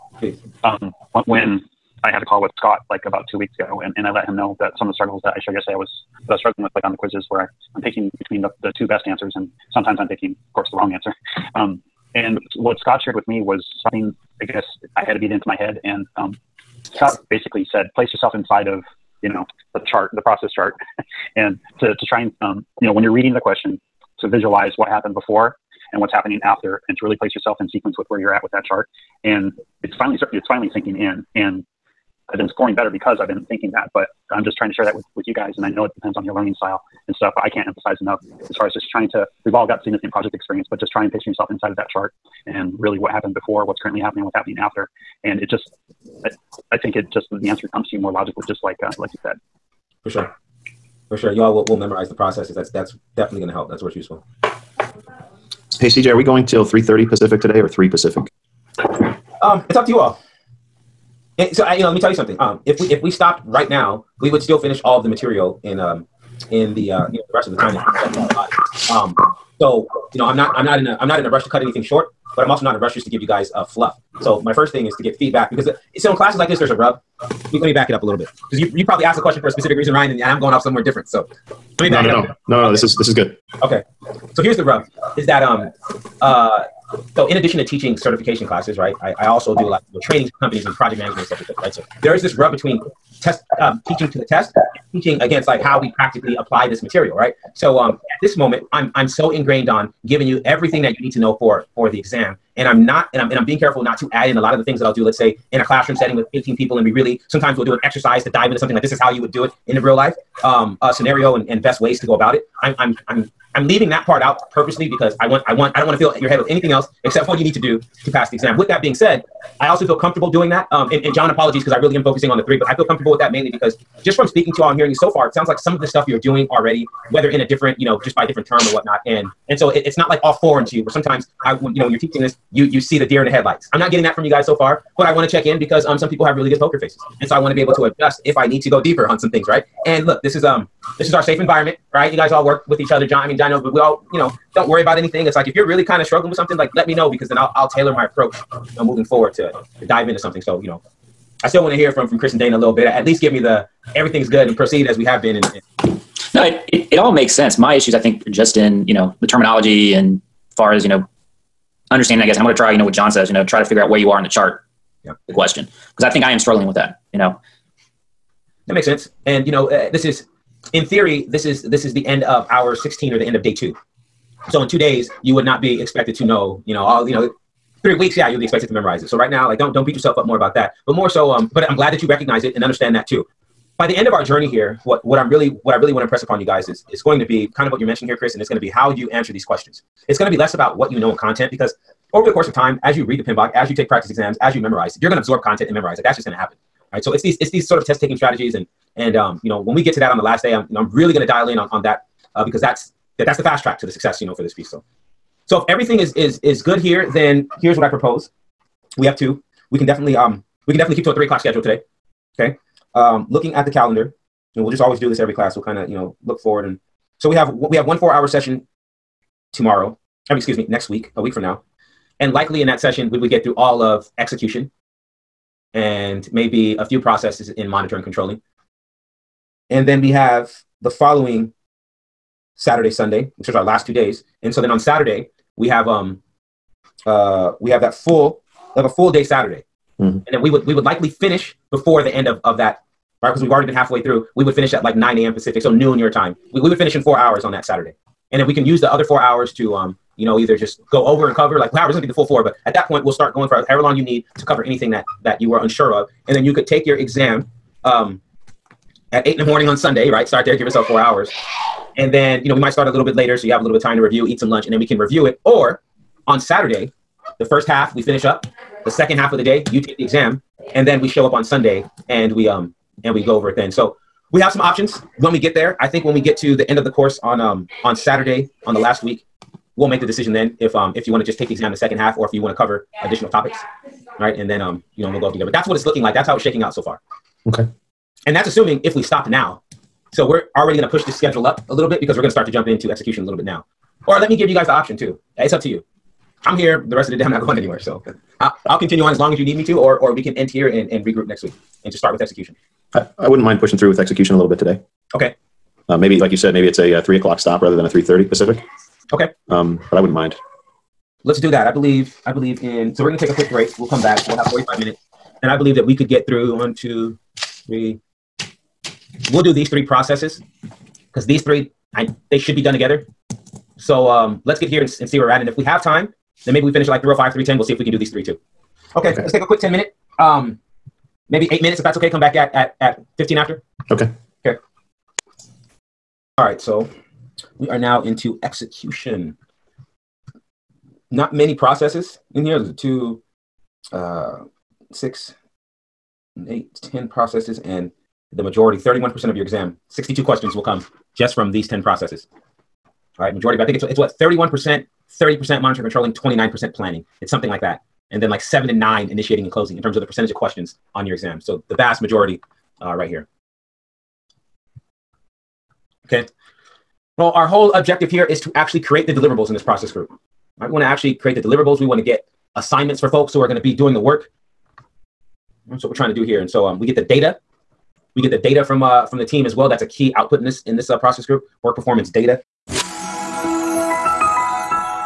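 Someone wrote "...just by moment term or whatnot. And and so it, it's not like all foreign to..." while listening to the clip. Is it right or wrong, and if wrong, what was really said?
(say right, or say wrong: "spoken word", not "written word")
wrong: "different", not "moment".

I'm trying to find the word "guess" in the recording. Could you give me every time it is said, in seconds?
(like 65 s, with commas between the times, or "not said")
14 s, 162 s.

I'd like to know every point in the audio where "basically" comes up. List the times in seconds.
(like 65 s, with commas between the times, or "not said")
17 s.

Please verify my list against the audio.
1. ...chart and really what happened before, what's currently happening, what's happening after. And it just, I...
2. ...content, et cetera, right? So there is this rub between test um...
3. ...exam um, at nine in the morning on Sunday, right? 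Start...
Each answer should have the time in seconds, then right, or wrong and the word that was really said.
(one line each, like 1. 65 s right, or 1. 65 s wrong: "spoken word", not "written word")
1. 41 s right
2. 90 s wrong: "management", not "content"
3. 256 s wrong: "eight", not "nine".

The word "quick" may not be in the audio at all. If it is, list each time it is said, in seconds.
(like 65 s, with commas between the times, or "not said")
313 s, 329 s.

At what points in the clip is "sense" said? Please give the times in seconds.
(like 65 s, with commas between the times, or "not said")
157 s, 168 s.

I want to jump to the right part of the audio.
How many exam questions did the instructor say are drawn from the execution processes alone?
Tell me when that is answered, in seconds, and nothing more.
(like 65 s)
349 s.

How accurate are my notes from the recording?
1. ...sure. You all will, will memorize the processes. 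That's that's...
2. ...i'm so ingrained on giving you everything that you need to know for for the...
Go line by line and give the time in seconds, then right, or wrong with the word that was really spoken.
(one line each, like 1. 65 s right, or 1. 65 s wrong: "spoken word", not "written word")
1. 51 s right
2. 98 s right.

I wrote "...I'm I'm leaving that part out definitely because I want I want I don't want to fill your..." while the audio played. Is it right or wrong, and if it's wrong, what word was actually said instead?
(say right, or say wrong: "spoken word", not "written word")
wrong: "purposely", not "definitely".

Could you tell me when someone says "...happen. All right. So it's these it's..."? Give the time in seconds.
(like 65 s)
196 s.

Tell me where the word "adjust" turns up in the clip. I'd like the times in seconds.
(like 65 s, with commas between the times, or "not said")
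137 s.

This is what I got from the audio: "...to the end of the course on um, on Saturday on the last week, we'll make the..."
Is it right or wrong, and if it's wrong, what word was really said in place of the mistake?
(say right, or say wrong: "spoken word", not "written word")
right.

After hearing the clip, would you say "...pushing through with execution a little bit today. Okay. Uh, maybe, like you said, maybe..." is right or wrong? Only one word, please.
right.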